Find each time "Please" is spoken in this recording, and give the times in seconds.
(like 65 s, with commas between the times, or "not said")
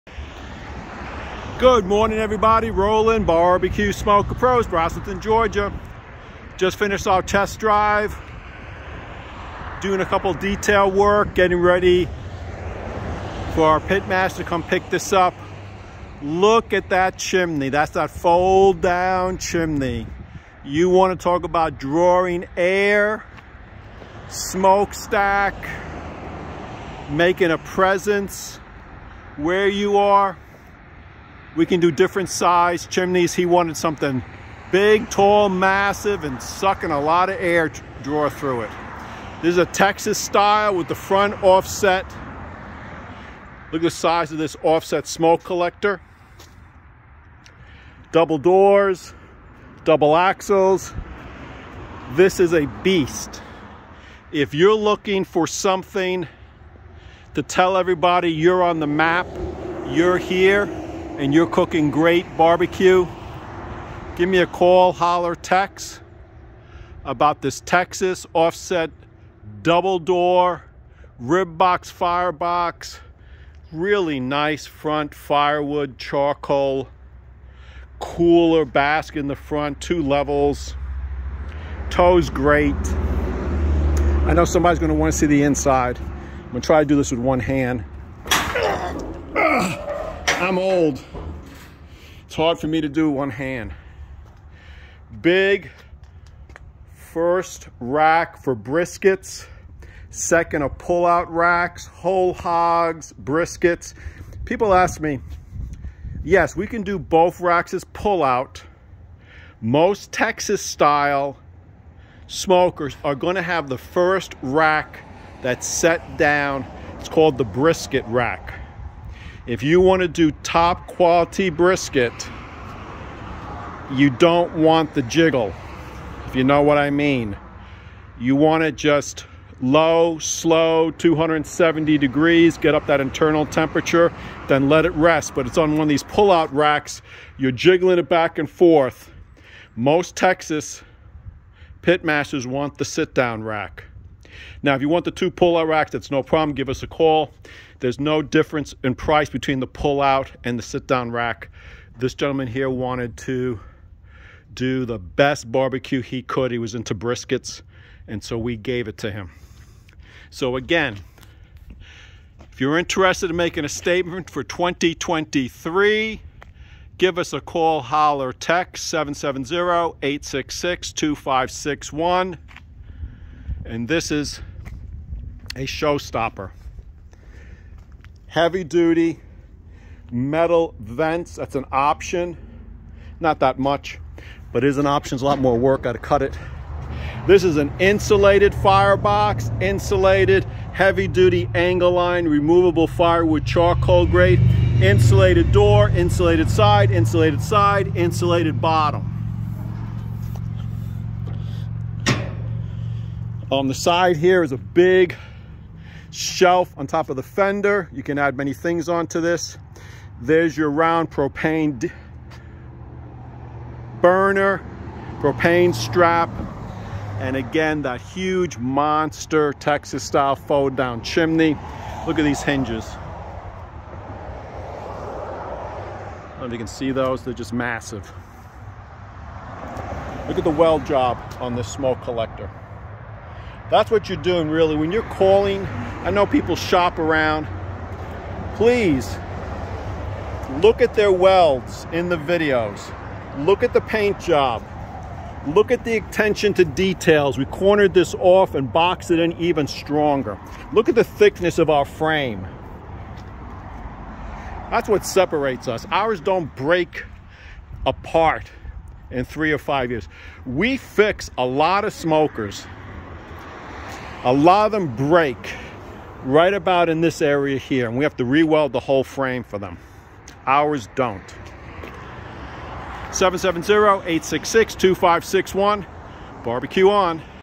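238 s.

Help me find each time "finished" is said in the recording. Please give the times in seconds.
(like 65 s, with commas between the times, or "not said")
6 s.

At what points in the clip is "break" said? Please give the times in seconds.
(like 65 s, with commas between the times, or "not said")
256 s, 265 s.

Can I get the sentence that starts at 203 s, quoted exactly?
On the side here is a big shelf on top of the fender.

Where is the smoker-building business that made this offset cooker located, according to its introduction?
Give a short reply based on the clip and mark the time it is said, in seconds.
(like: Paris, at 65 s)
Rossington, Georgia, at 4 s.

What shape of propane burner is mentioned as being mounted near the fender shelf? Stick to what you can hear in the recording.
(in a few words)
round.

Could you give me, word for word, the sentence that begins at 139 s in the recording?
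Most Texas pit masters want the sit-down rack.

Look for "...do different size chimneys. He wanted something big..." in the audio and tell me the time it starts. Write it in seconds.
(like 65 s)
31 s.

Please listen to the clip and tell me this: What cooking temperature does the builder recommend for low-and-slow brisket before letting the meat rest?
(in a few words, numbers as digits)
270 degrees.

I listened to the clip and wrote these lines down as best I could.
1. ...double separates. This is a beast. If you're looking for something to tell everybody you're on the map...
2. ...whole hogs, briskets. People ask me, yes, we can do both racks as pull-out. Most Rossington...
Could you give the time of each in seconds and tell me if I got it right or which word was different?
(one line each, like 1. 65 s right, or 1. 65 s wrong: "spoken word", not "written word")
1. 49 s wrong: "axles", not "separates"
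2. 101 s wrong: "Texas", not "Rossington".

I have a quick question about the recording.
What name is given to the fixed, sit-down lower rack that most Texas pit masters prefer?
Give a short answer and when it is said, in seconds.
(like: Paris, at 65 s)
brisket rack, at 117 s.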